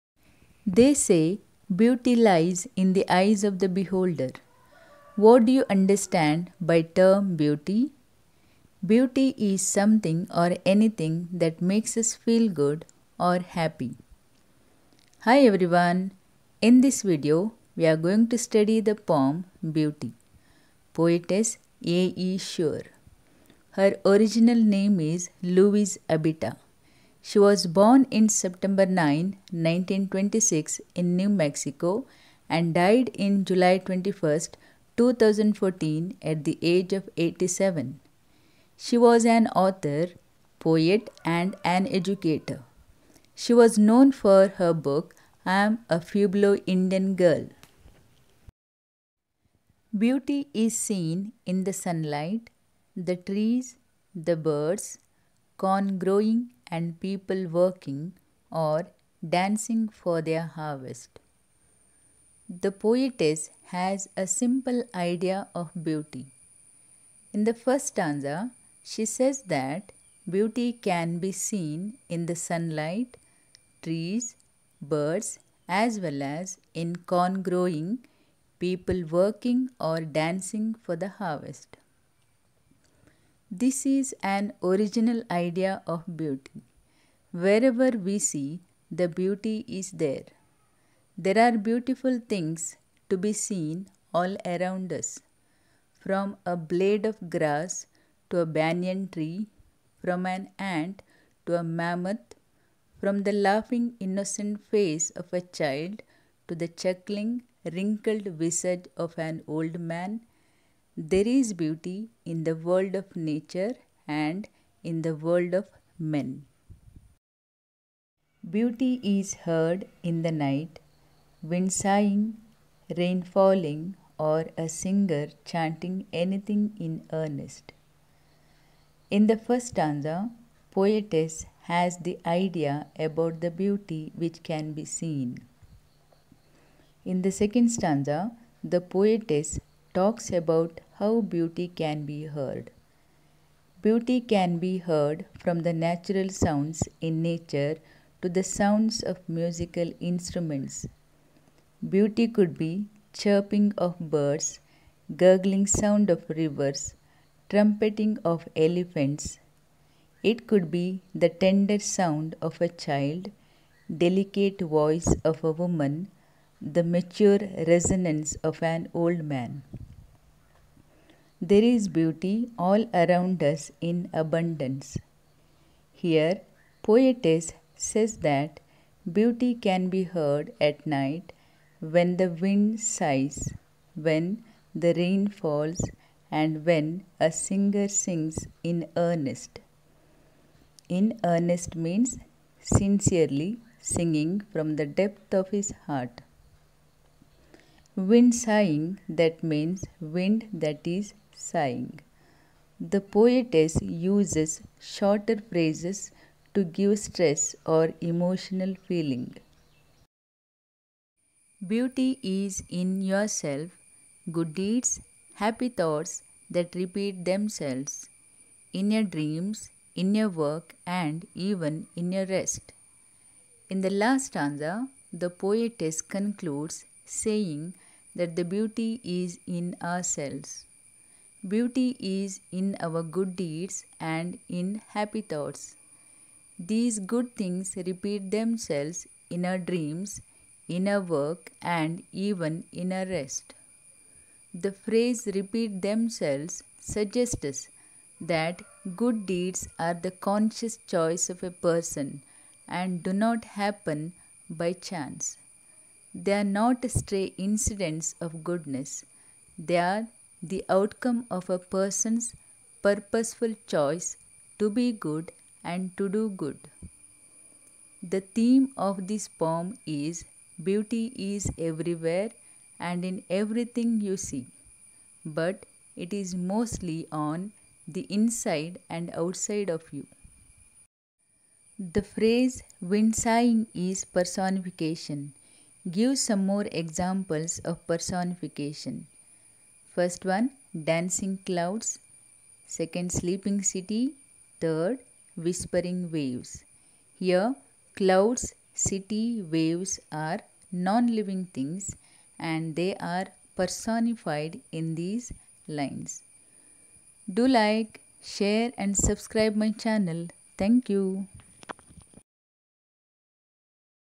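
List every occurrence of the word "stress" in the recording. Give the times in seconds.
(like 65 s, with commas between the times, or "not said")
206 s.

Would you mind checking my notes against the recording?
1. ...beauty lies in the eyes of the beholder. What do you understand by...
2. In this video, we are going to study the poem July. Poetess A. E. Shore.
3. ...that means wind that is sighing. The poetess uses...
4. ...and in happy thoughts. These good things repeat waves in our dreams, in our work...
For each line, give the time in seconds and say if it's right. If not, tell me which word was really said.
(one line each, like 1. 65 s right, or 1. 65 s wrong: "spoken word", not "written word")
1. 1 s right
2. 16 s wrong: "Beauty", not "July"
3. 199 s right
4. 233 s wrong: "themselves", not "waves".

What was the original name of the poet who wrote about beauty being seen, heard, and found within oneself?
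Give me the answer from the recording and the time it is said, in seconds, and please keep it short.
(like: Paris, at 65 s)
Louise Abeita, at 25 s.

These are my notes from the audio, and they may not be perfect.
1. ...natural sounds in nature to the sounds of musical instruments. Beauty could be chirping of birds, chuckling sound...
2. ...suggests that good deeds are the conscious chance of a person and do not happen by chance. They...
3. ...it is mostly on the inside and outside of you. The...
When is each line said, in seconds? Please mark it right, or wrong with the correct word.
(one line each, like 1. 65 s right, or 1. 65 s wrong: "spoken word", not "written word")
1. 145 s wrong: "gurgling", not "chuckling"
2. 246 s wrong: "choice", not "chance"
3. 275 s right.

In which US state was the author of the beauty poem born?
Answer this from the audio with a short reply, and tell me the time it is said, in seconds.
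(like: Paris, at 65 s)
New Mexico, at 31 s.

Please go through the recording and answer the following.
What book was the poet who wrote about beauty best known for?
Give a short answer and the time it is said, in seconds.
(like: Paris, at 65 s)
I Am a Pueblo Indian Girl, at 45 s.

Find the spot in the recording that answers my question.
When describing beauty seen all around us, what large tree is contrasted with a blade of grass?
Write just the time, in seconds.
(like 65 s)
98 s.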